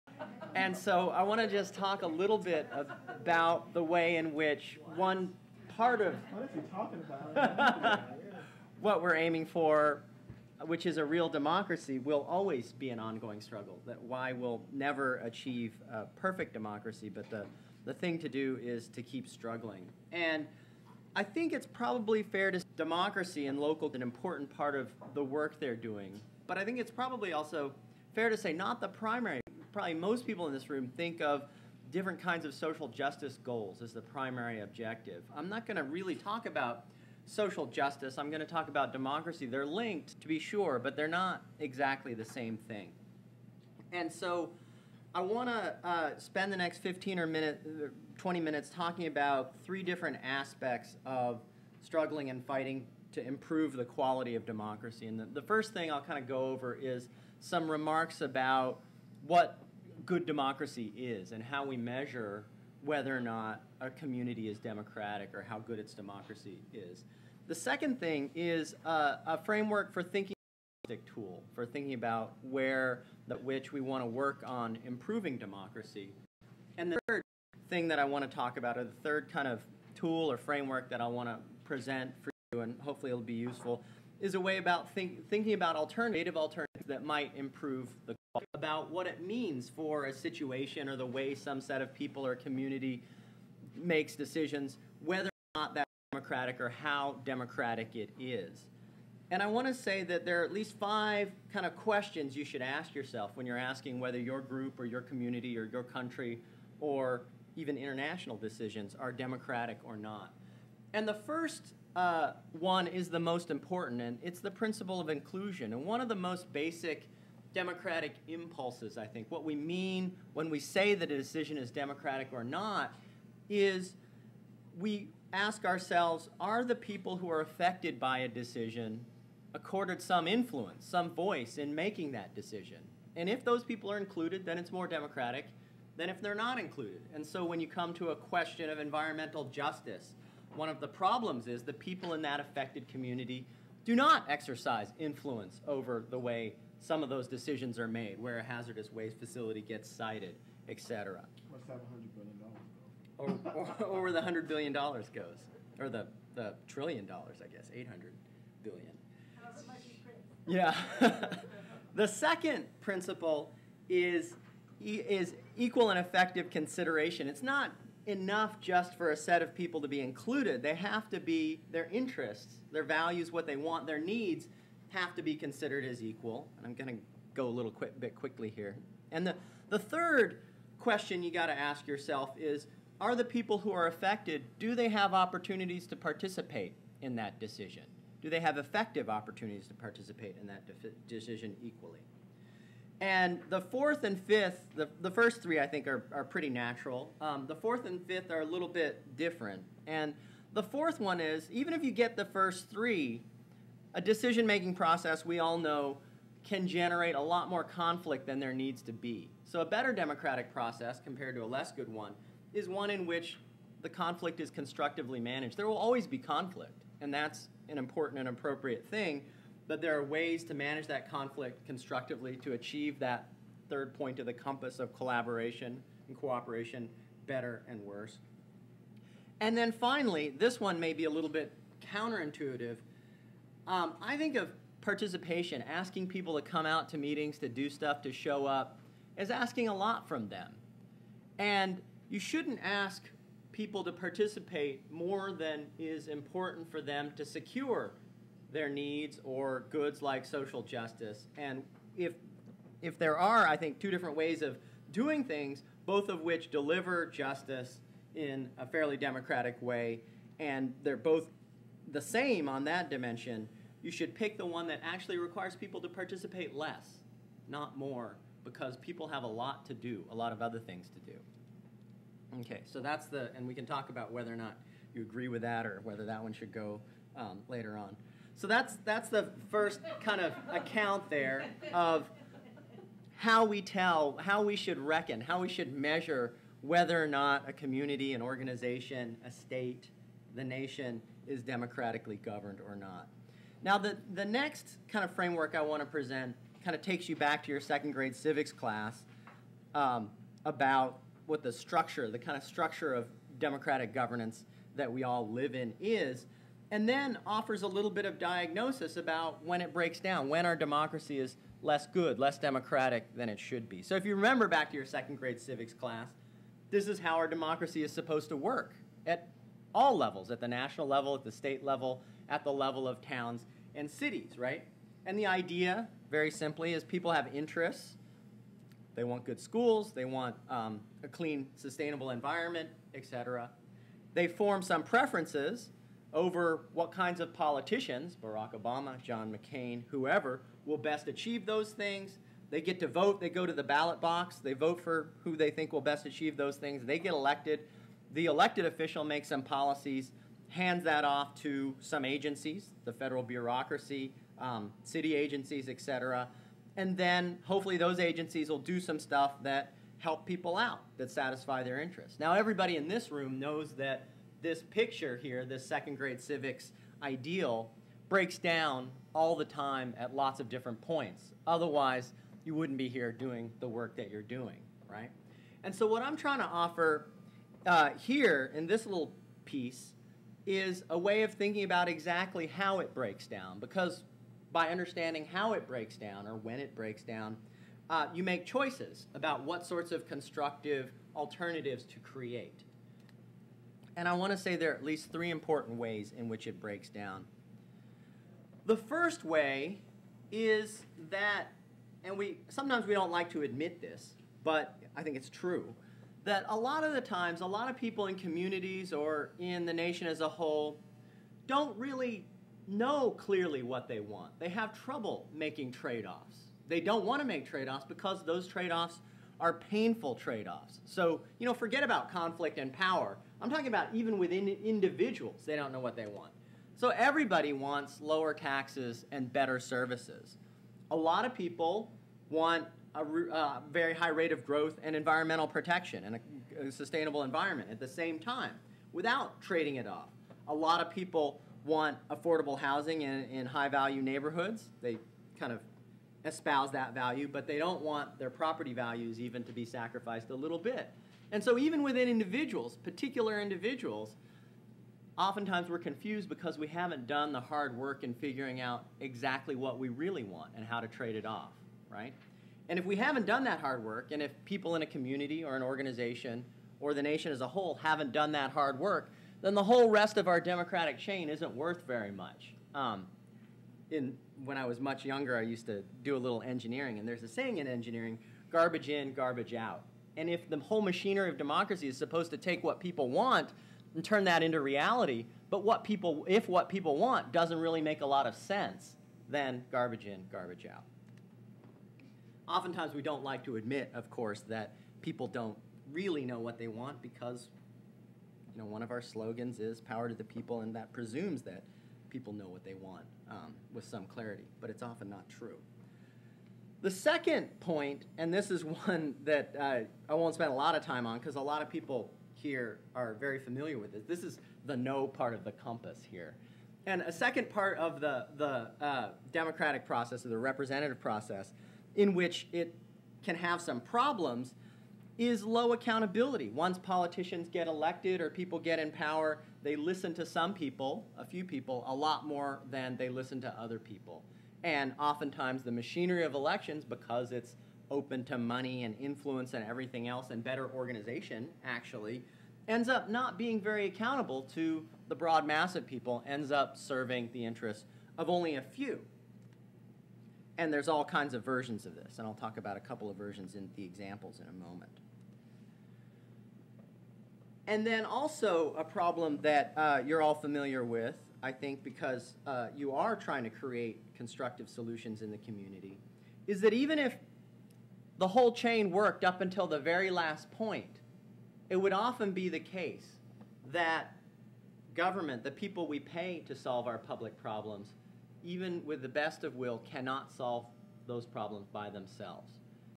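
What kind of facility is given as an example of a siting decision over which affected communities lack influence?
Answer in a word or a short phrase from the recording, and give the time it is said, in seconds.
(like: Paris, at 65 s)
hazardous waste facility, at 148 s.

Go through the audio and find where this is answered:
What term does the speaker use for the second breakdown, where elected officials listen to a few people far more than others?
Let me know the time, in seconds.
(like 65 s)
525 s.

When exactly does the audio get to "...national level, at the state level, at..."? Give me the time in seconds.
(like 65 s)
320 s.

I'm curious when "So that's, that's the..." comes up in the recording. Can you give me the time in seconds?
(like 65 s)
278 s.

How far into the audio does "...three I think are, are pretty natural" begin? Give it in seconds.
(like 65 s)
195 s.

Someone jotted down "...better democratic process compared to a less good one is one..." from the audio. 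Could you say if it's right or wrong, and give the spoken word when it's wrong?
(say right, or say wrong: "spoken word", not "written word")
right.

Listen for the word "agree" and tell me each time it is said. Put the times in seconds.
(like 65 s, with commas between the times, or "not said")
275 s.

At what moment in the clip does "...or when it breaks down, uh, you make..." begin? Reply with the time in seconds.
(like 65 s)
386 s.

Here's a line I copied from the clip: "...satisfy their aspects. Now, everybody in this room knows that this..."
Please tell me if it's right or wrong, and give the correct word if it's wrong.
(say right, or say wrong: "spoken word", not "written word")
wrong: "interests", not "aspects".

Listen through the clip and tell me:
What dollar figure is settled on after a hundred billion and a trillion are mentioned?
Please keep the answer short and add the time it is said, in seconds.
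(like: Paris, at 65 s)
$800 billion, at 157 s.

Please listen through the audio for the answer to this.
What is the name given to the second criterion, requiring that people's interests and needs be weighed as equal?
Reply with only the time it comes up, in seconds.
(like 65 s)
165 s.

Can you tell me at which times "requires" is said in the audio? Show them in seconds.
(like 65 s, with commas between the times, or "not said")
265 s.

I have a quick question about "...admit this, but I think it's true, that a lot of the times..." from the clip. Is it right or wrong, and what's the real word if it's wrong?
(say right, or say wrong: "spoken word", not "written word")
right.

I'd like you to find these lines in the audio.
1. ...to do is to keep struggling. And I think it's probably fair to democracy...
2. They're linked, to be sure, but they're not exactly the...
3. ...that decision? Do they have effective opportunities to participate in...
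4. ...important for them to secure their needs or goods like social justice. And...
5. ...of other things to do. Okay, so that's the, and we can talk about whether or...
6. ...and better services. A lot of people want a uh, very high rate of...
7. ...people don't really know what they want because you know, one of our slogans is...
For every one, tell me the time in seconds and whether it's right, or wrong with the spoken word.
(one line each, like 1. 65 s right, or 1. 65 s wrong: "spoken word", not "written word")
1. 18 s right
2. 39 s right
3. 187 s right
4. 246 s right
5. 270 s right
6. 429 s right
7. 495 s right.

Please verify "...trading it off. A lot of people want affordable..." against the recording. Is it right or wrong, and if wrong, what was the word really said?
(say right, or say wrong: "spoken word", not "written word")
right.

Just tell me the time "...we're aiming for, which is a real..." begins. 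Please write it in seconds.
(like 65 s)
9 s.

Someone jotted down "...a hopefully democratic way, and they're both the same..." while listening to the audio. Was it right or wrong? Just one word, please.
wrong.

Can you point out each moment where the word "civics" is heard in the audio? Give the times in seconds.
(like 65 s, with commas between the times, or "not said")
298 s, 315 s, 366 s.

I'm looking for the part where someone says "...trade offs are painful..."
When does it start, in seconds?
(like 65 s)
418 s.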